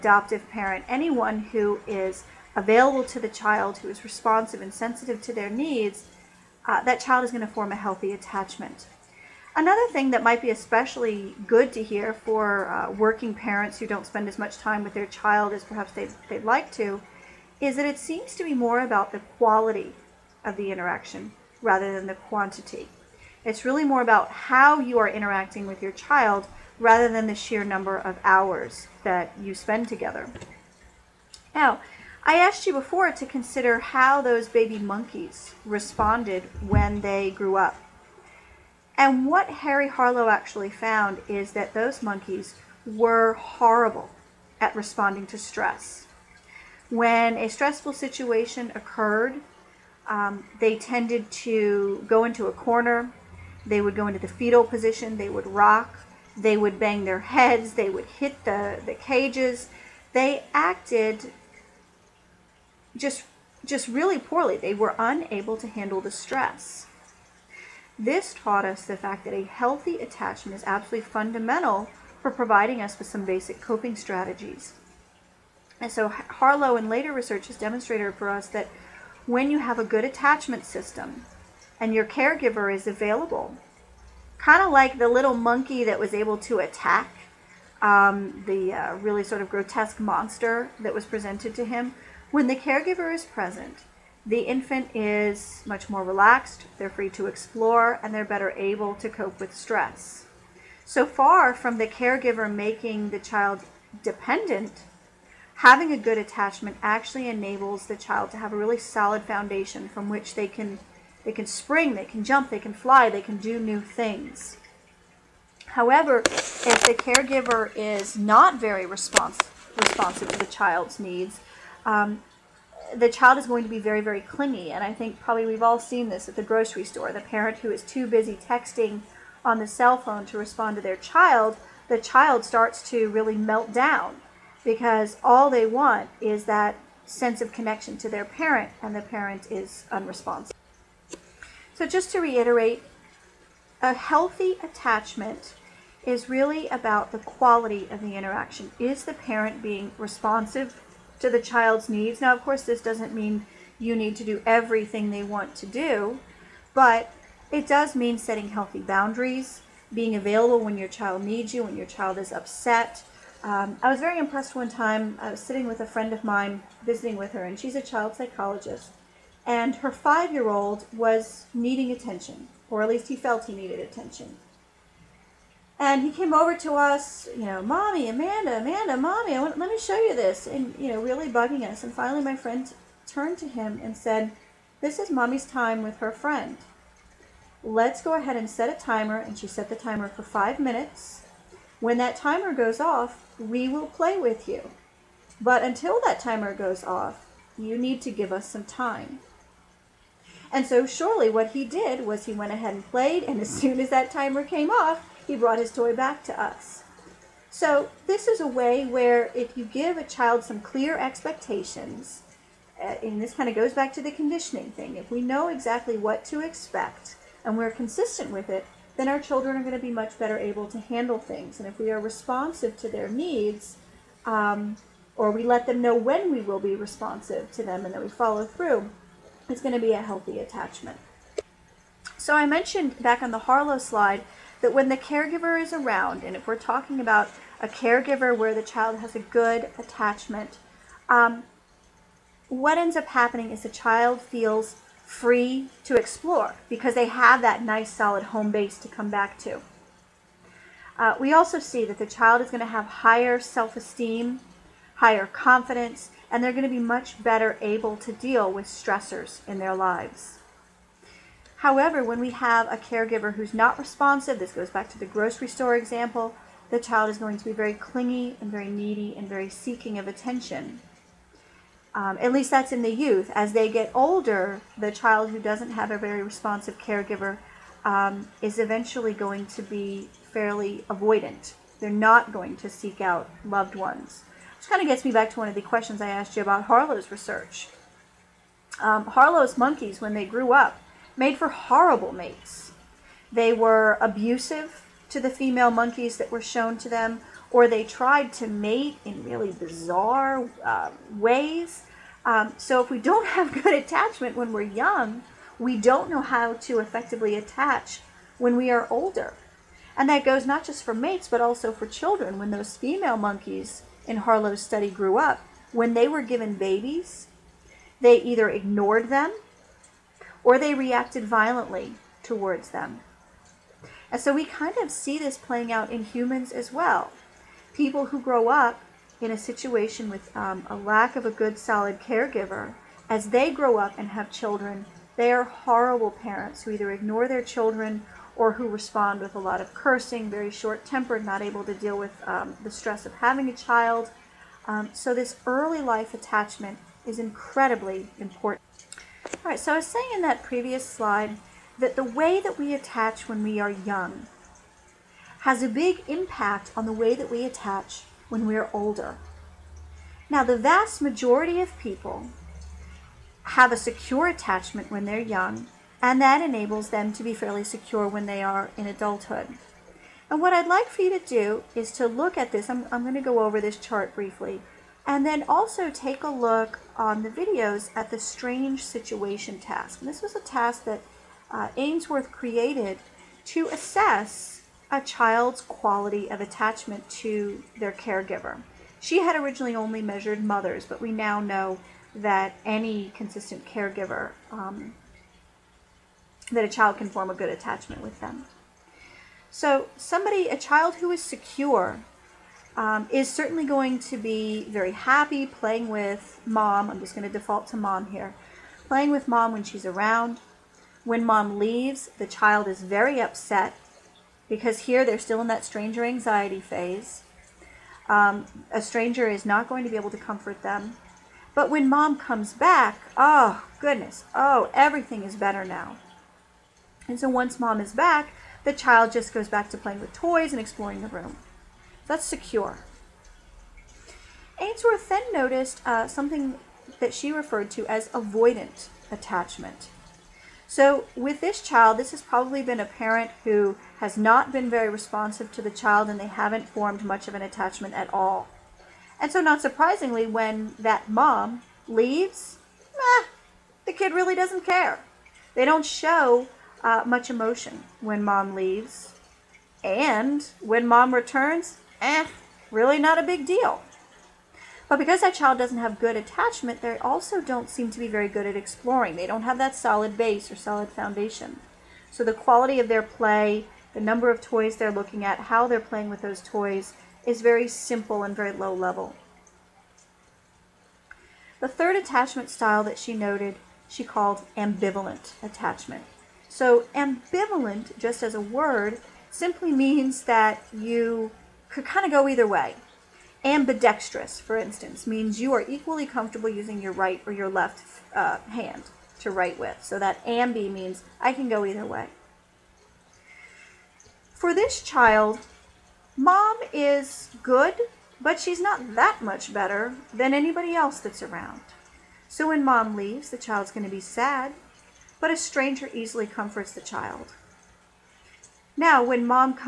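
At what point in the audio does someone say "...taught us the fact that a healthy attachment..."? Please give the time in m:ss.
1:08.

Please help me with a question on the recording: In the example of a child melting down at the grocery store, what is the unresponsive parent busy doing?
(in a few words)
Texting on the cell phone.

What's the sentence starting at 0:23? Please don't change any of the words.
It's really more about how you are interacting with your child rather than the sheer number of hours that you spend together.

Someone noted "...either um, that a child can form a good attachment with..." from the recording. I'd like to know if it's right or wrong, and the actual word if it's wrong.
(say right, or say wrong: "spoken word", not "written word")
wrong: "caregiver", not "either".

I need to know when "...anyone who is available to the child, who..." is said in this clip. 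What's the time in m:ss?
0:00.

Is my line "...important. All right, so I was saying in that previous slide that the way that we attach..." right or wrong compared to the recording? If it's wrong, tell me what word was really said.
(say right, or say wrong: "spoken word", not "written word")
right.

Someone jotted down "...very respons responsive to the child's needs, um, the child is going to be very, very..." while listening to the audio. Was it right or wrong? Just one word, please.
right.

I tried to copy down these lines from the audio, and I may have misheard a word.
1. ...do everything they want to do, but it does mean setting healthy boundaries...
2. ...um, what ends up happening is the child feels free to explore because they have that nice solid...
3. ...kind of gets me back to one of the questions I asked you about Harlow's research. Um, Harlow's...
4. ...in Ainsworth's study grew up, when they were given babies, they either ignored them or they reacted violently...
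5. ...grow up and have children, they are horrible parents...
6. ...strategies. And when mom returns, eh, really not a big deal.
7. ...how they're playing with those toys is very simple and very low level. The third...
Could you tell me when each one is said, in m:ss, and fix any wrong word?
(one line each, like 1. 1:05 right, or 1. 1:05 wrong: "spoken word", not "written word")
1. 2:34 right
2. 4:01 right
3. 4:44 right
4. 5:14 wrong: "Harlow", not "Ainsworth"
5. 5:33 right
6. 7:38 wrong: "leaves", not "strategies"
7. 7:55 right.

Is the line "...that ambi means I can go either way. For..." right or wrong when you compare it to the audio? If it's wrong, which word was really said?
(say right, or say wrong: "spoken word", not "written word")
right.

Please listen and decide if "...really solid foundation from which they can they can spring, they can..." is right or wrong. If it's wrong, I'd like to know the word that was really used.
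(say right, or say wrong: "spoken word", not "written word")
right.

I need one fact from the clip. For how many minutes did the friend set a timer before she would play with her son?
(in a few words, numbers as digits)
5.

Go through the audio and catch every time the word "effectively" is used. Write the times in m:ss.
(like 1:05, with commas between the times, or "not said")
5:06.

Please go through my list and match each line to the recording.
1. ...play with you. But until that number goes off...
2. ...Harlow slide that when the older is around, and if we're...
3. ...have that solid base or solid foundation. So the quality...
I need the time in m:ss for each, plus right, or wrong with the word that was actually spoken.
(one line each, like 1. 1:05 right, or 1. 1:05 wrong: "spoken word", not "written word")
1. 3:13 wrong: "timer", not "number"
2. 3:53 wrong: "caregiver", not "older"
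3. 7:49 right.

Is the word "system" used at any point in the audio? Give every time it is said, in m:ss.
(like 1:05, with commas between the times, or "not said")
1:20.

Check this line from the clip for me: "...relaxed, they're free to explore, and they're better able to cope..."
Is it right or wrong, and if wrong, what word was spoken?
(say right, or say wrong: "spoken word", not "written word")
right.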